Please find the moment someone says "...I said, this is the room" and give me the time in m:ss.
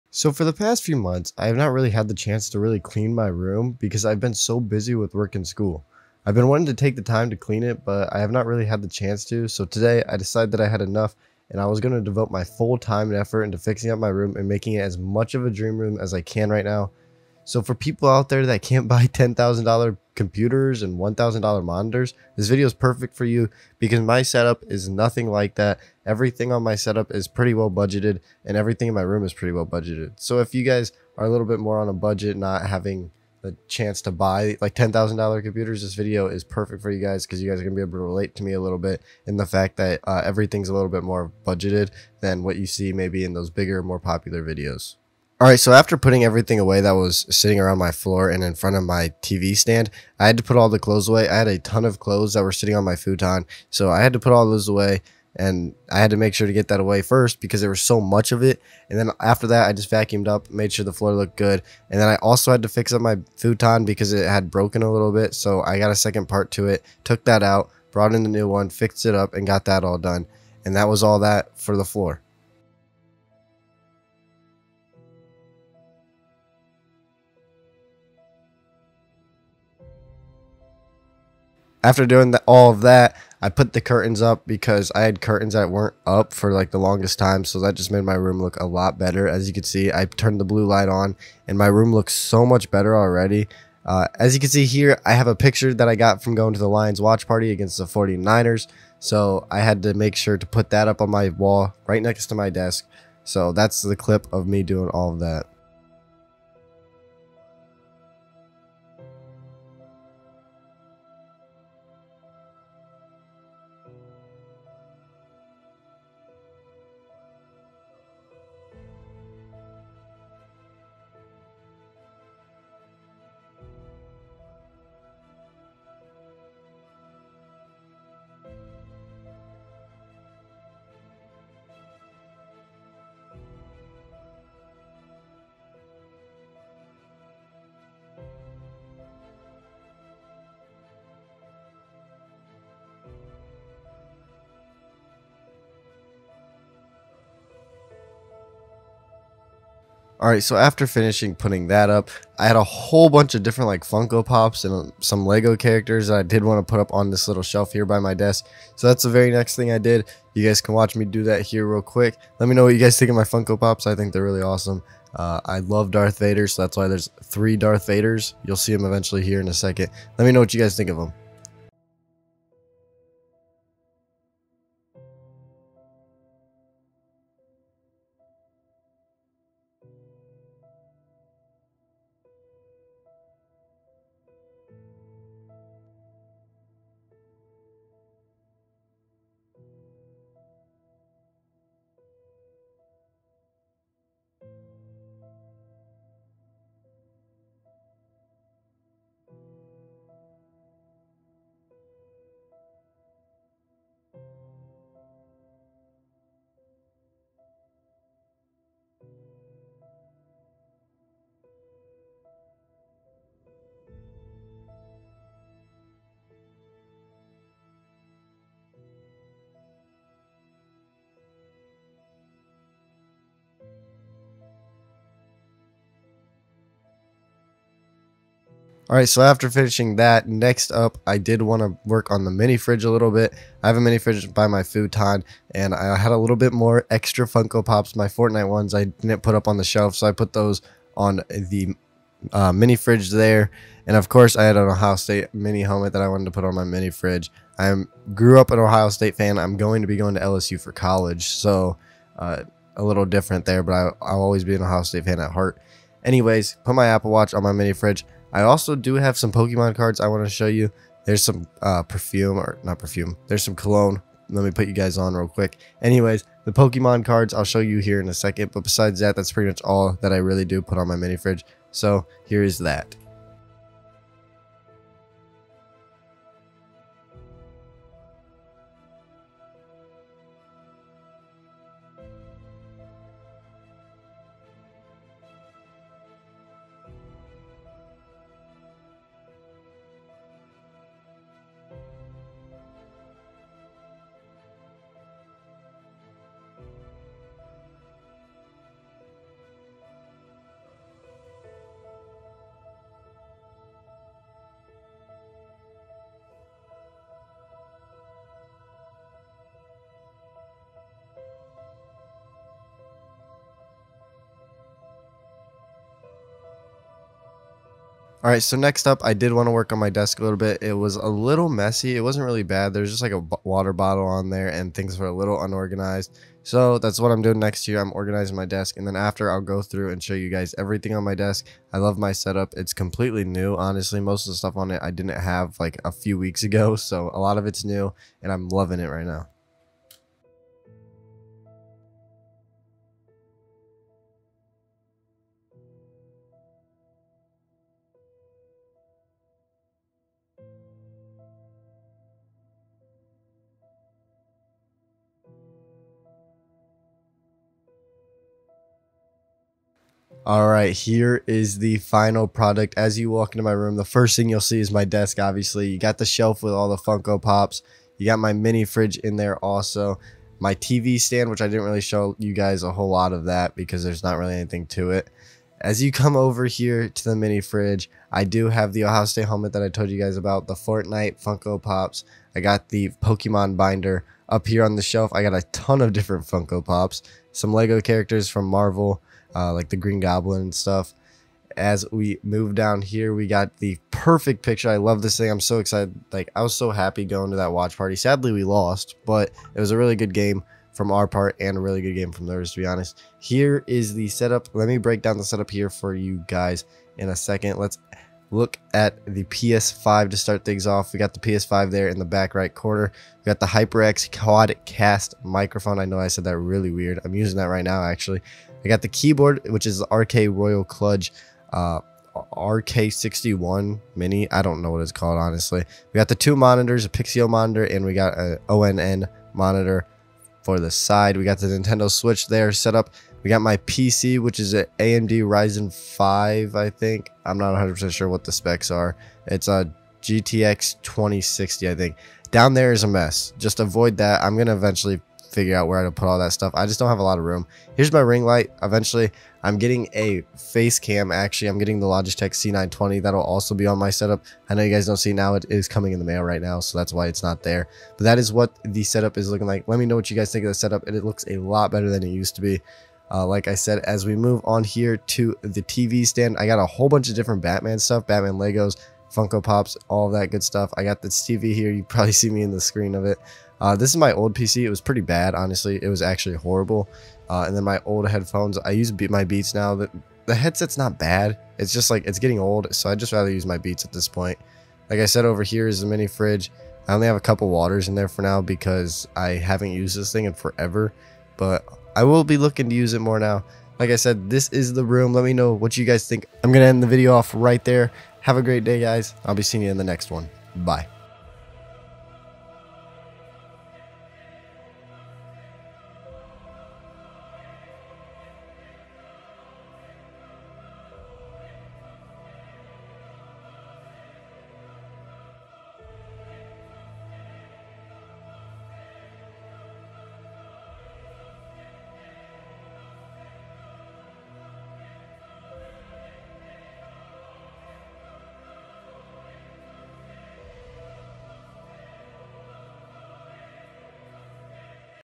8:13.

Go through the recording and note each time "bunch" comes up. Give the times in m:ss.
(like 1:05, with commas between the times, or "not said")
2:33, 7:46.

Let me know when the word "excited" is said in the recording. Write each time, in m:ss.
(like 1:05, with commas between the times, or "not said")
6:35.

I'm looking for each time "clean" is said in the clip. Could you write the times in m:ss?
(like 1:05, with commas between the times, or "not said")
0:02, 0:07.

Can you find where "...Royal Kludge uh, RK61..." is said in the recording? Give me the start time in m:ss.
7:00.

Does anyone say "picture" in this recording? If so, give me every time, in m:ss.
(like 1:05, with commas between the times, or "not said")
1:35, 6:34.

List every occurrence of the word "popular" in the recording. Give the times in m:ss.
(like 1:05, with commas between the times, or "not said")
0:43.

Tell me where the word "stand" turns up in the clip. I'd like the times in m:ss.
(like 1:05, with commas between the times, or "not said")
0:49, 6:11, 7:46.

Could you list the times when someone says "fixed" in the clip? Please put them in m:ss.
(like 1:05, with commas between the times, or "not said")
1:08.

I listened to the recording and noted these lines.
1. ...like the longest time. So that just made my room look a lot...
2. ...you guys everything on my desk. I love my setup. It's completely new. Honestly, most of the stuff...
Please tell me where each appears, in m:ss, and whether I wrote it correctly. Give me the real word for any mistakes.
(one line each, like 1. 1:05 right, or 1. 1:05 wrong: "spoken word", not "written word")
1. 1:26 right
2. 5:30 right.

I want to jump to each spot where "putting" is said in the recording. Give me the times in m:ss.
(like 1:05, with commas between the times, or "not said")
0:45, 2:31.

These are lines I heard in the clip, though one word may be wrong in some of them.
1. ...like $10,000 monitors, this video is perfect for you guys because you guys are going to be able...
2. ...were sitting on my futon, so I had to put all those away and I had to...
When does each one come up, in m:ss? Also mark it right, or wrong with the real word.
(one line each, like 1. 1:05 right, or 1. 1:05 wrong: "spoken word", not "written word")
1. 0:34 wrong: "computers", not "monitors"
2. 0:52 right.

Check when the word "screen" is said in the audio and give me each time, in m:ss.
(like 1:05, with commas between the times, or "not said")
7:52.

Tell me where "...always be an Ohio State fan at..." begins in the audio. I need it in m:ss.
4:14.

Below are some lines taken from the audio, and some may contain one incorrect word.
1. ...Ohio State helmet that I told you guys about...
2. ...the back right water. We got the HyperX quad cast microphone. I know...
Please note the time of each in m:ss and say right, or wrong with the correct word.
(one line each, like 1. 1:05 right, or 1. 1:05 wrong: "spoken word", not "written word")
1. 6:18 right
2. 6:51 wrong: "corner", not "water".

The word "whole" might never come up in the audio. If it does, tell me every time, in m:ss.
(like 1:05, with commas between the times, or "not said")
2:32, 6:12, 7:46.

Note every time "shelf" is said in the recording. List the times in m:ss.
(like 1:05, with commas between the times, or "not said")
2:37, 3:59, 6:06, 6:24.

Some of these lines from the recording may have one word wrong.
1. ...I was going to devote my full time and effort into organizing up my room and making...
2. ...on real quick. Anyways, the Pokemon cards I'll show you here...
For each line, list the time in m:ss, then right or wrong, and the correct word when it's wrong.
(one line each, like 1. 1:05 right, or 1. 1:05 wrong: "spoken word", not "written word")
1. 0:11 wrong: "fixing", not "organizing"
2. 4:24 right.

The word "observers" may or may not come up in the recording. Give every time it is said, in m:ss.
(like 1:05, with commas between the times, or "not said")
not said.